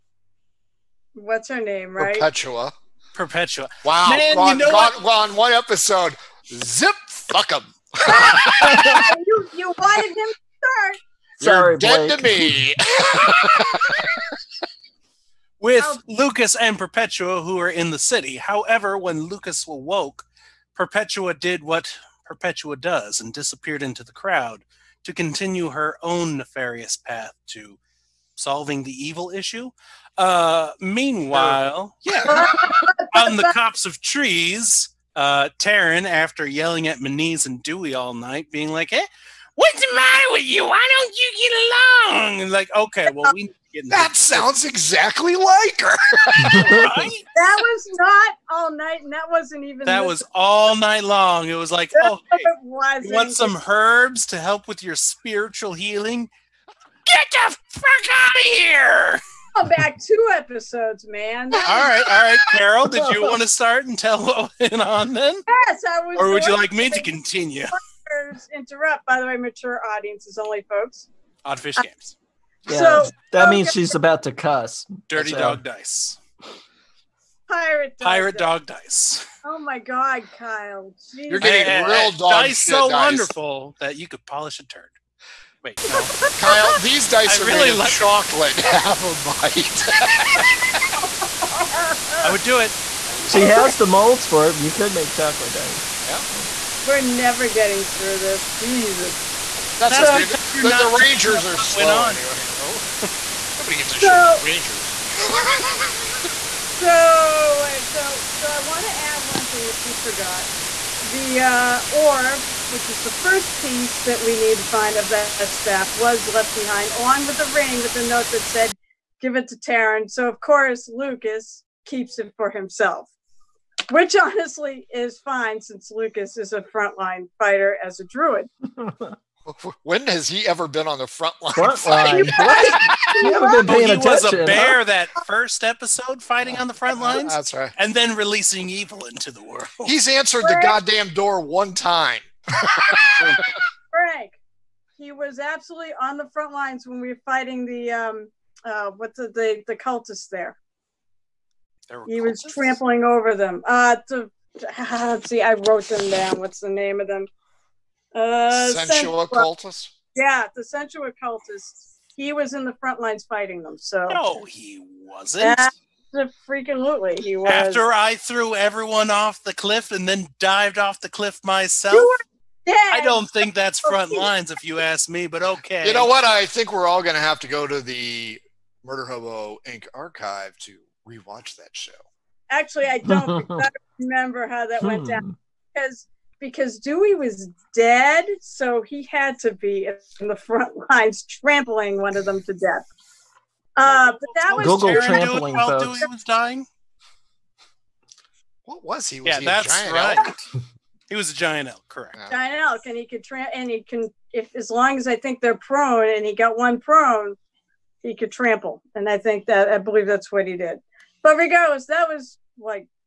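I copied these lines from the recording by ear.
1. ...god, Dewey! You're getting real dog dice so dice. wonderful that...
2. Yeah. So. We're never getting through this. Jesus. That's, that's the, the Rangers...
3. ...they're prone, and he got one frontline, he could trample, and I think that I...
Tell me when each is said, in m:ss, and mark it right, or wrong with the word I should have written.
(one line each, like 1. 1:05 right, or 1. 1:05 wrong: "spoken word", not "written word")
1. 1:19 wrong: "Kyle", not "Dewey"
2. 1:36 right
3. 3:25 wrong: "prone", not "frontline".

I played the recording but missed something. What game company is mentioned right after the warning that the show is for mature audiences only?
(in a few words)
Odd Fish Games.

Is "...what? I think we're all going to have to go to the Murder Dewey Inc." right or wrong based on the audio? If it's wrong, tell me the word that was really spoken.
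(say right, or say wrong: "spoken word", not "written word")
wrong: "Hobo", not "Dewey".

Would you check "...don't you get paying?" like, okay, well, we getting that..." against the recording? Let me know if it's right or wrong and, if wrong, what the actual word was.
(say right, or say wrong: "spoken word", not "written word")
wrong: "along", not "paying".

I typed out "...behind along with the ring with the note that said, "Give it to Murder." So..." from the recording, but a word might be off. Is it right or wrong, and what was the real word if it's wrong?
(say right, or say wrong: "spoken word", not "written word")
wrong: "Taryn", not "Murder".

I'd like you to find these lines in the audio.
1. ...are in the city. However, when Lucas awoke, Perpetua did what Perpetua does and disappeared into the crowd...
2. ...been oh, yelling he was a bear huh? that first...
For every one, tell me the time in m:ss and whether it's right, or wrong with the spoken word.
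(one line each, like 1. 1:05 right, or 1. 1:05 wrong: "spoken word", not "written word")
1. 0:17 right
2. 2:12 wrong: "paying", not "yelling".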